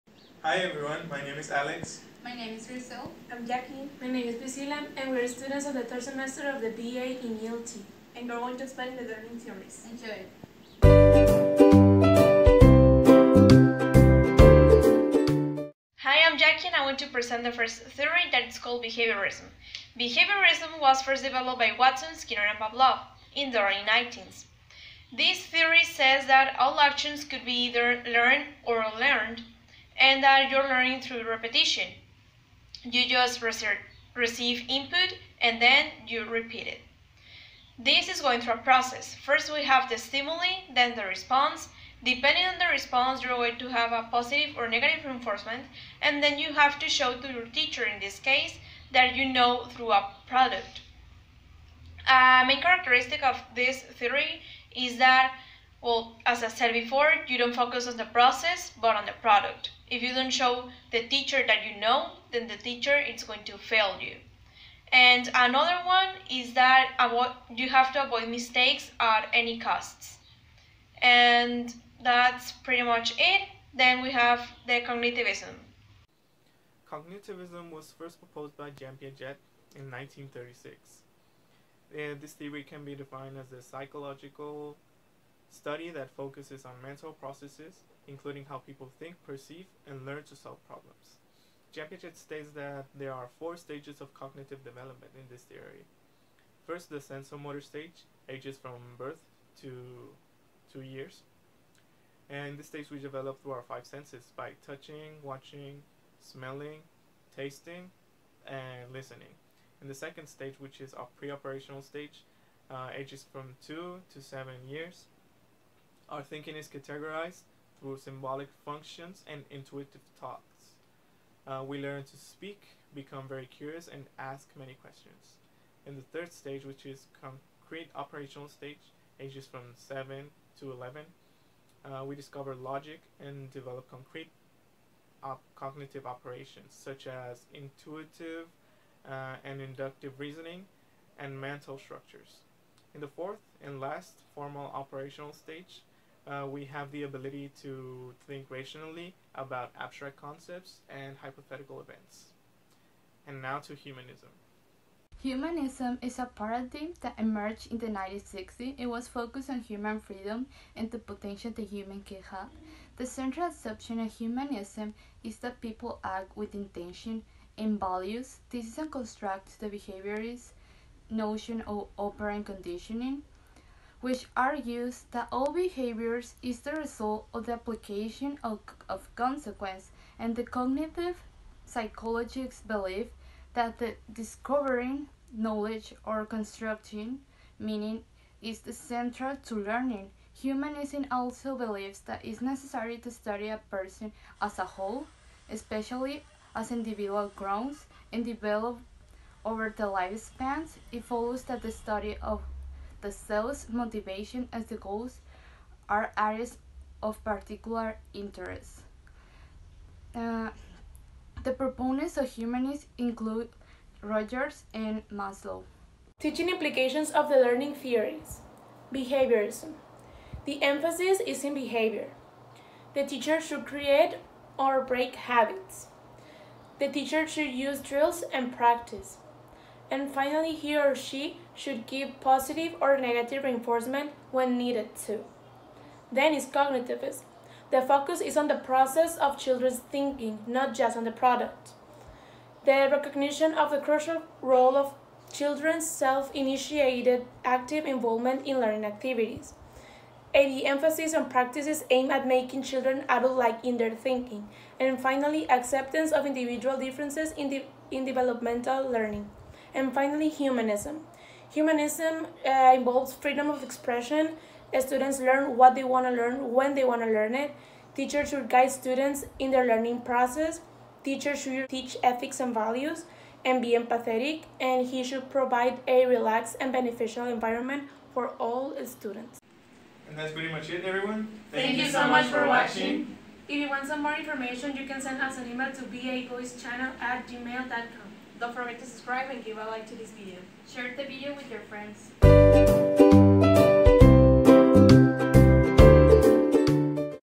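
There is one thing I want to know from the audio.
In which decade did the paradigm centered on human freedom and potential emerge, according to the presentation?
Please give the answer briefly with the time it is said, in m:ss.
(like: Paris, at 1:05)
1960s, at 2:37.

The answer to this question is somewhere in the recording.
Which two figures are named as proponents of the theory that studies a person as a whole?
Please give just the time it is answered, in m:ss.
3:34.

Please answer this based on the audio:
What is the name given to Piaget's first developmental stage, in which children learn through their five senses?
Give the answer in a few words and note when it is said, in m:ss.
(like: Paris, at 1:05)
sensomotor stage, at 1:36.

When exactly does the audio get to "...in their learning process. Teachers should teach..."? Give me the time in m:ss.
4:29.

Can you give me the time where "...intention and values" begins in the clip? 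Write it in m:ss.
2:46.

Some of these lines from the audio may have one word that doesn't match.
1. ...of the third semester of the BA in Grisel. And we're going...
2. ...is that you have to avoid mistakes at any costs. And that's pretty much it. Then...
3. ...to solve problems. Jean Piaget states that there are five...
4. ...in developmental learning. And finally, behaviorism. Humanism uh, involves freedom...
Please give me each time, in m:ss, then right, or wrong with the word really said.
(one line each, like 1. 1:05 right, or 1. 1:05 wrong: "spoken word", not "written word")
1. 0:05 wrong: "ELT", not "Grisel"
2. 1:06 right
3. 1:30 wrong: "four", not "five"
4. 4:17 wrong: "humanism", not "behaviorism".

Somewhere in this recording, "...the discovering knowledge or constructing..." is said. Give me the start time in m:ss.
3:03.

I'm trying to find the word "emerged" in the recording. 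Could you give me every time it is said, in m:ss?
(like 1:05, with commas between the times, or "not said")
2:37.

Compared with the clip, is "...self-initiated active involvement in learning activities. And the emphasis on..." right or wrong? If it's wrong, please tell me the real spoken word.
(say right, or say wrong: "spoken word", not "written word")
right.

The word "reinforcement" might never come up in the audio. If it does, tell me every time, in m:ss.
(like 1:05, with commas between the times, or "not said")
0:45, 3:53.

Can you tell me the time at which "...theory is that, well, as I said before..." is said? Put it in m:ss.
0:53.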